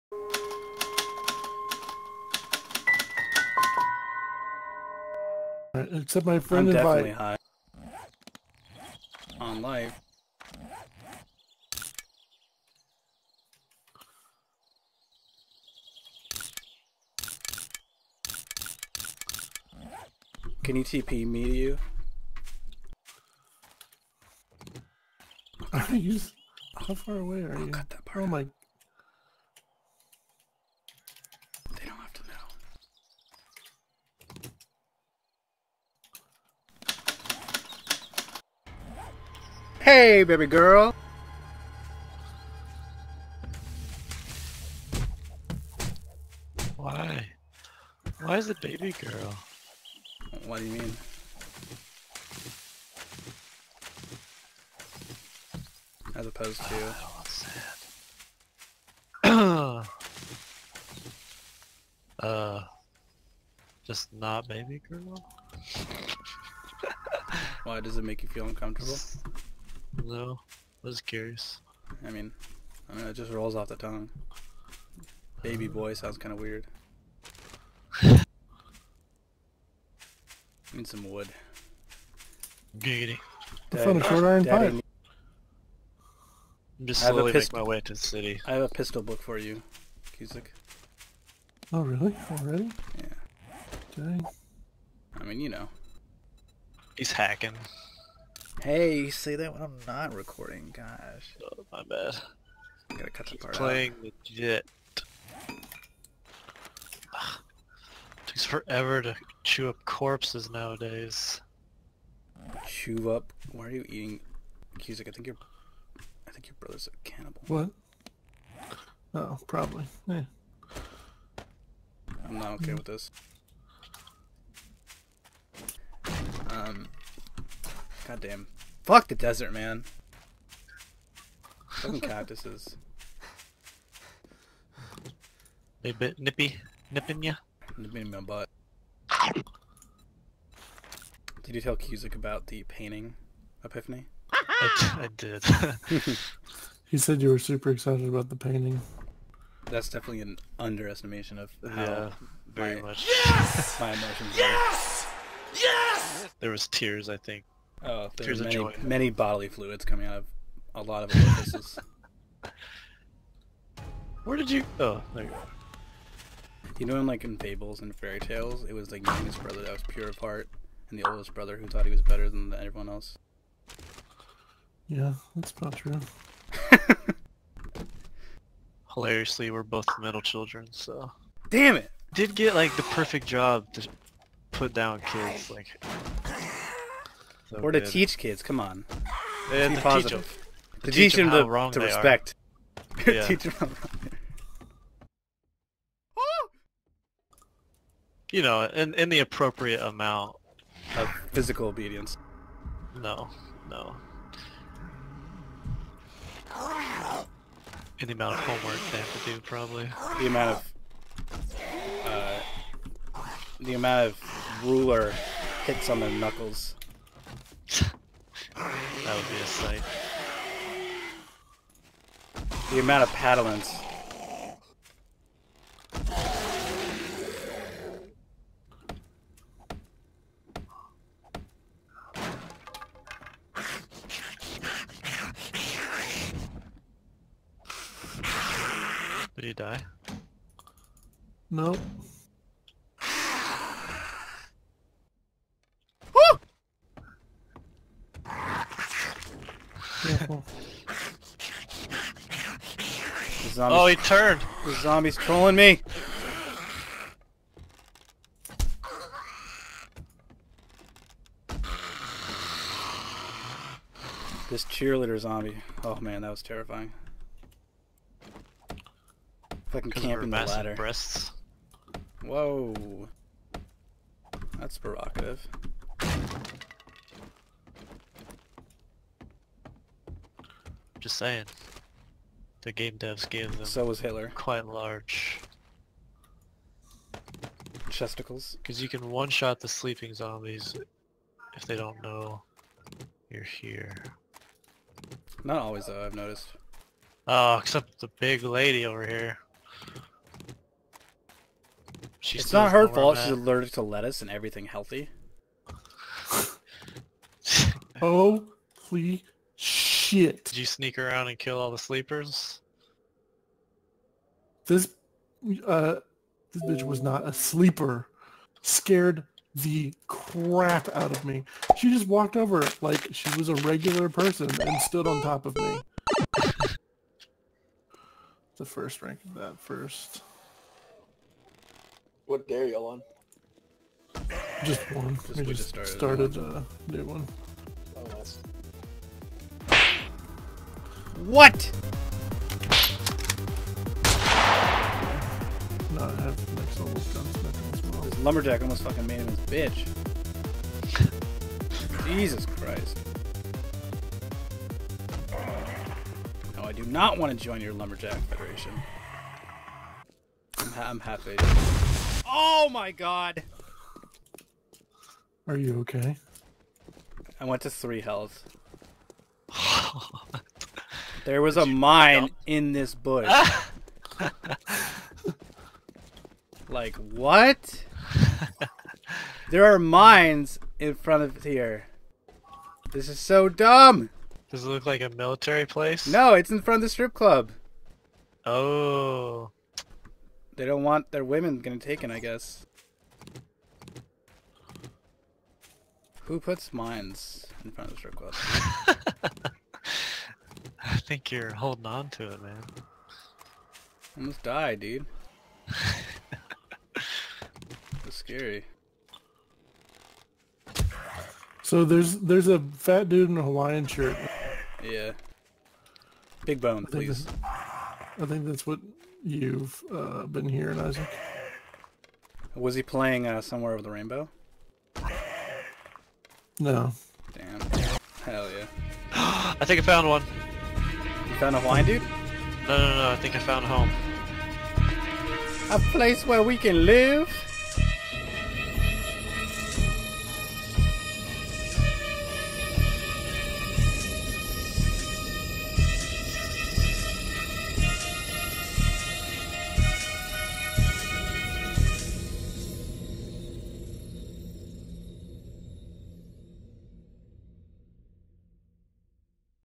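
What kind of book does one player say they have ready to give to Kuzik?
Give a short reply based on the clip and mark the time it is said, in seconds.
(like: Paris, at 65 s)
Pistol book, at 88 s.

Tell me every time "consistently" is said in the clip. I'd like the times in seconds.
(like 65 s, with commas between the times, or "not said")
not said.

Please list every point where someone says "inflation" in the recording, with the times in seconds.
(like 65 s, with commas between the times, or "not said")
not said.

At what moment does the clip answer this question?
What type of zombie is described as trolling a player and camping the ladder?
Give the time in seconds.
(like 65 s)
264 s.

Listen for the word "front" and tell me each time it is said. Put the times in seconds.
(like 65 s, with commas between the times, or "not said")
380 s, 386 s, 397 s.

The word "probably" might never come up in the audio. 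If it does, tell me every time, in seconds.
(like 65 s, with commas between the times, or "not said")
119 s, 209 s.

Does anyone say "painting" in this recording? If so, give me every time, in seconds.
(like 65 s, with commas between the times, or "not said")
142 s, 148 s.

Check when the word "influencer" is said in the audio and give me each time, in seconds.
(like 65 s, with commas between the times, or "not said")
not said.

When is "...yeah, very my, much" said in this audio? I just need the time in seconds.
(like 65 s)
151 s.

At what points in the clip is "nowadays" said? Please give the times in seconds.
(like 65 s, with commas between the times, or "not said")
110 s.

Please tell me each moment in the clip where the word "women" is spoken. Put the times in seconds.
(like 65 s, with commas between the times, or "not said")
391 s.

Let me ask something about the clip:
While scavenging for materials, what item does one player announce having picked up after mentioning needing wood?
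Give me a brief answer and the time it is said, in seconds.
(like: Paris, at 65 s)
Short iron pipe, at 84 s.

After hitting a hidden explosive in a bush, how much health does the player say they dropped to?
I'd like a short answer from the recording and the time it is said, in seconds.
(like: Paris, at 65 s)
3, at 367 s.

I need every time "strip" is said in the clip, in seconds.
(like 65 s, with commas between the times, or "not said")
386 s, 397 s.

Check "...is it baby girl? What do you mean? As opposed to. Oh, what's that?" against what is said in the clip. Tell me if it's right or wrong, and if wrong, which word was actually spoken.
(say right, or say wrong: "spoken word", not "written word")
right.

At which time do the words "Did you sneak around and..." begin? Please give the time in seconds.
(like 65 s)
310 s.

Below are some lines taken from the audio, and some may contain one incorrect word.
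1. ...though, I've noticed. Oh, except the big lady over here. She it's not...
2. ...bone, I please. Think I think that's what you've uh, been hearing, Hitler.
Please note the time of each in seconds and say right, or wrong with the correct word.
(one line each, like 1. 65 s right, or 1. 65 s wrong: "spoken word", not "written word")
1. 295 s right
2. 416 s wrong: "Isaac", not "Hitler".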